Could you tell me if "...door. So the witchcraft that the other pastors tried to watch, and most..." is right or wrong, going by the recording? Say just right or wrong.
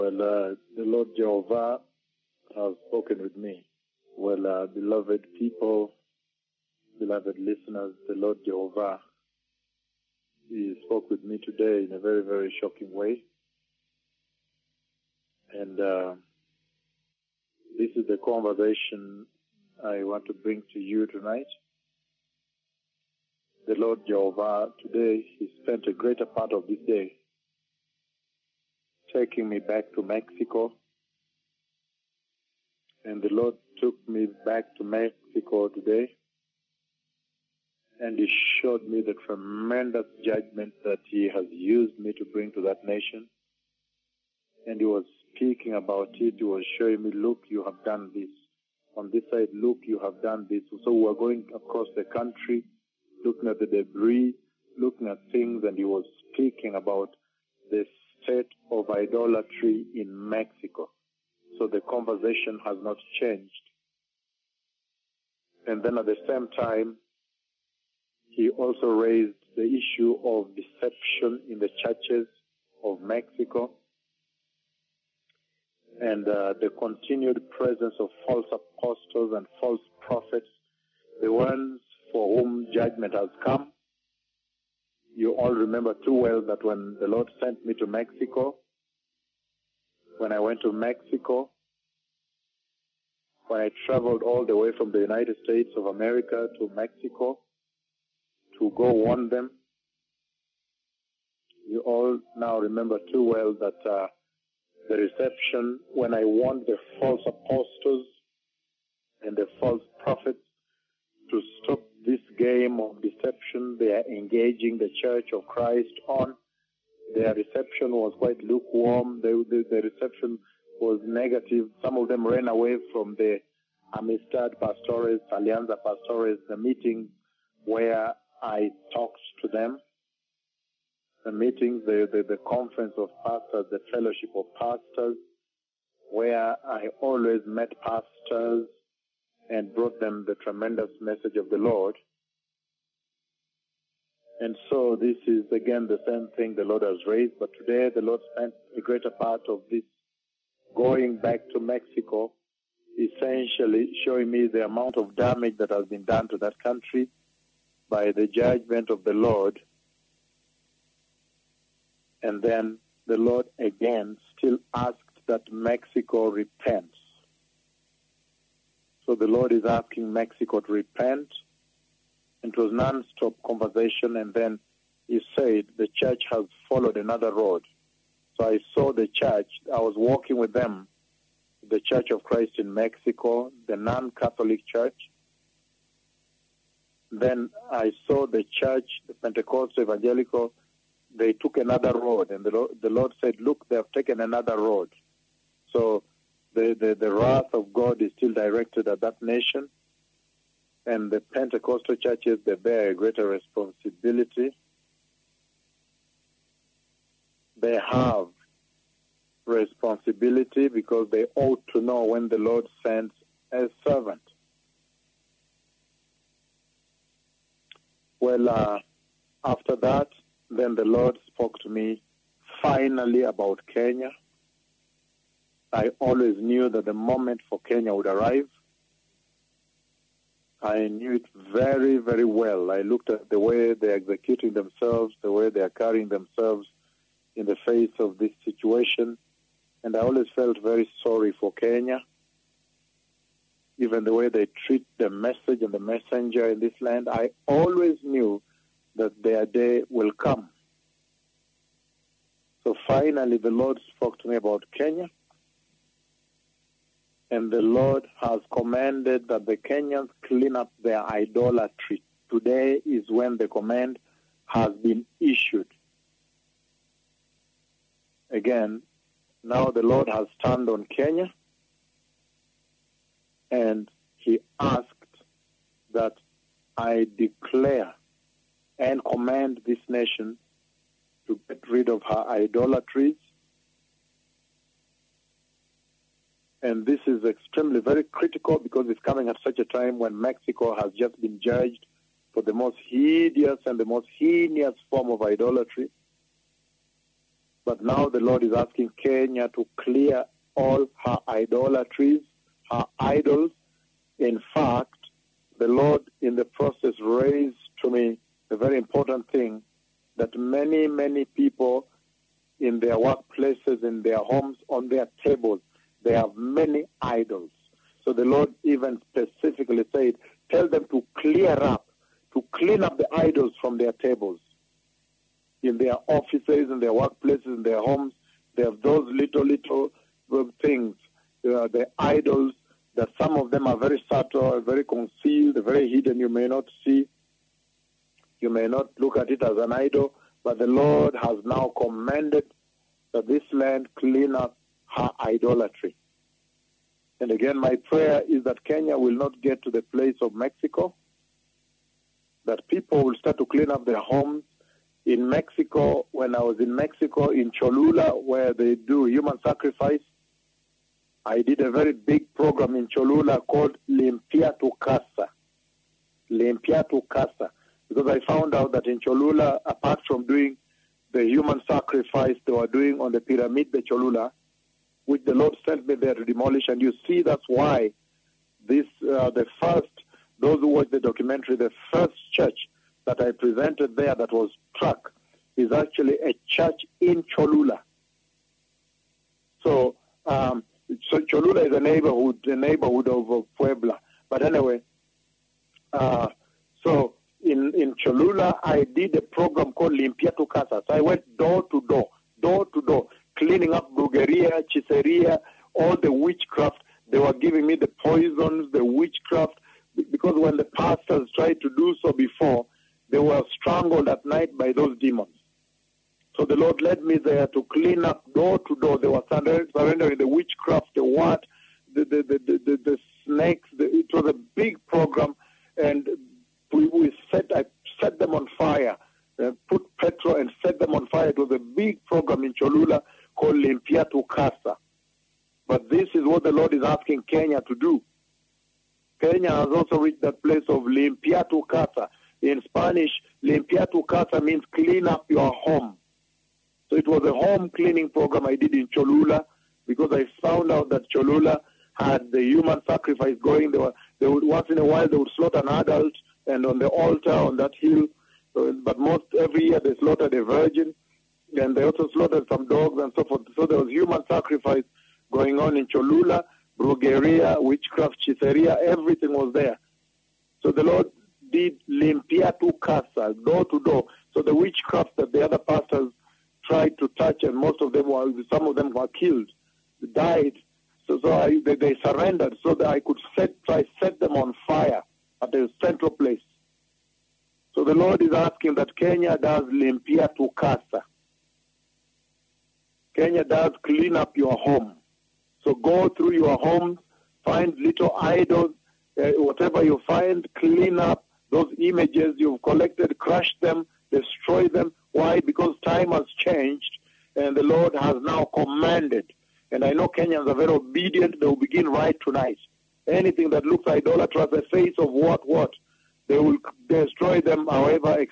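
wrong.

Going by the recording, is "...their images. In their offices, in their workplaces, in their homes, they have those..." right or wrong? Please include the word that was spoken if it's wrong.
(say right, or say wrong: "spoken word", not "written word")
wrong: "tables", not "images".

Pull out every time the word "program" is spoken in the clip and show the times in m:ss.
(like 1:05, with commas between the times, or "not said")
6:02, 6:39, 7:04, 7:12, 7:28.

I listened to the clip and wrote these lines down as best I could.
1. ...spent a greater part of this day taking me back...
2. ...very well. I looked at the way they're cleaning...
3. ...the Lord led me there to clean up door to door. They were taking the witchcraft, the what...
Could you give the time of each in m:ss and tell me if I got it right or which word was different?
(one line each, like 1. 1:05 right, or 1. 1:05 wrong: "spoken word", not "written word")
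1. 0:25 right
2. 3:51 wrong: "executing", not "cleaning"
3. 6:56 wrong: "surrendering", not "taking".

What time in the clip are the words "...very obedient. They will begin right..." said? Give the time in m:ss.
8:30.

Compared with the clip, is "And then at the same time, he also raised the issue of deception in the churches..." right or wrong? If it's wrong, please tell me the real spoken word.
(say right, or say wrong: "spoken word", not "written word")
right.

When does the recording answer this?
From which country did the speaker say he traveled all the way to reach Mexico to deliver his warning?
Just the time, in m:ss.
1:34.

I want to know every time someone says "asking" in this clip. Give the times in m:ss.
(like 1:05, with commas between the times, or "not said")
2:49, 4:58, 7:16, 8:08.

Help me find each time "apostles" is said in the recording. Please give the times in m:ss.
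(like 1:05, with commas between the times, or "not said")
1:18, 1:47.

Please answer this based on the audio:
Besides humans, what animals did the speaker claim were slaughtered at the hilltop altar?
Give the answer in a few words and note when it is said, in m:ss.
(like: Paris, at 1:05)
Dogs, at 7:42.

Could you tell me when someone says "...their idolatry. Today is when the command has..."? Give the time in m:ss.
4:20.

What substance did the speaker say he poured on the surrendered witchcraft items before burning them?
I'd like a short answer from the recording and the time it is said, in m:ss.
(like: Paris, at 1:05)
Petrol, at 7:10.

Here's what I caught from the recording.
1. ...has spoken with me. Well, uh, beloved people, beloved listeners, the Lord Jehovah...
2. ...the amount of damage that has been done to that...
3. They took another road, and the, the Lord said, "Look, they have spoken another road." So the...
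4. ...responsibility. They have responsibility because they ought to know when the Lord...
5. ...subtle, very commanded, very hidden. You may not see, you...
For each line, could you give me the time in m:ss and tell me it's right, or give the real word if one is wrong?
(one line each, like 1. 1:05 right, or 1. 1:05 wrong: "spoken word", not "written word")
1. 0:02 right
2. 2:34 right
3. 3:11 wrong: "taken", not "spoken"
4. 3:23 right
5. 5:34 wrong: "concealed", not "commanded".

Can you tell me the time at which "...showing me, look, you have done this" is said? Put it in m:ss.
0:46.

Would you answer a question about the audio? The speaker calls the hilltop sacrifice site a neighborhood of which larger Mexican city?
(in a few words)
Puebla.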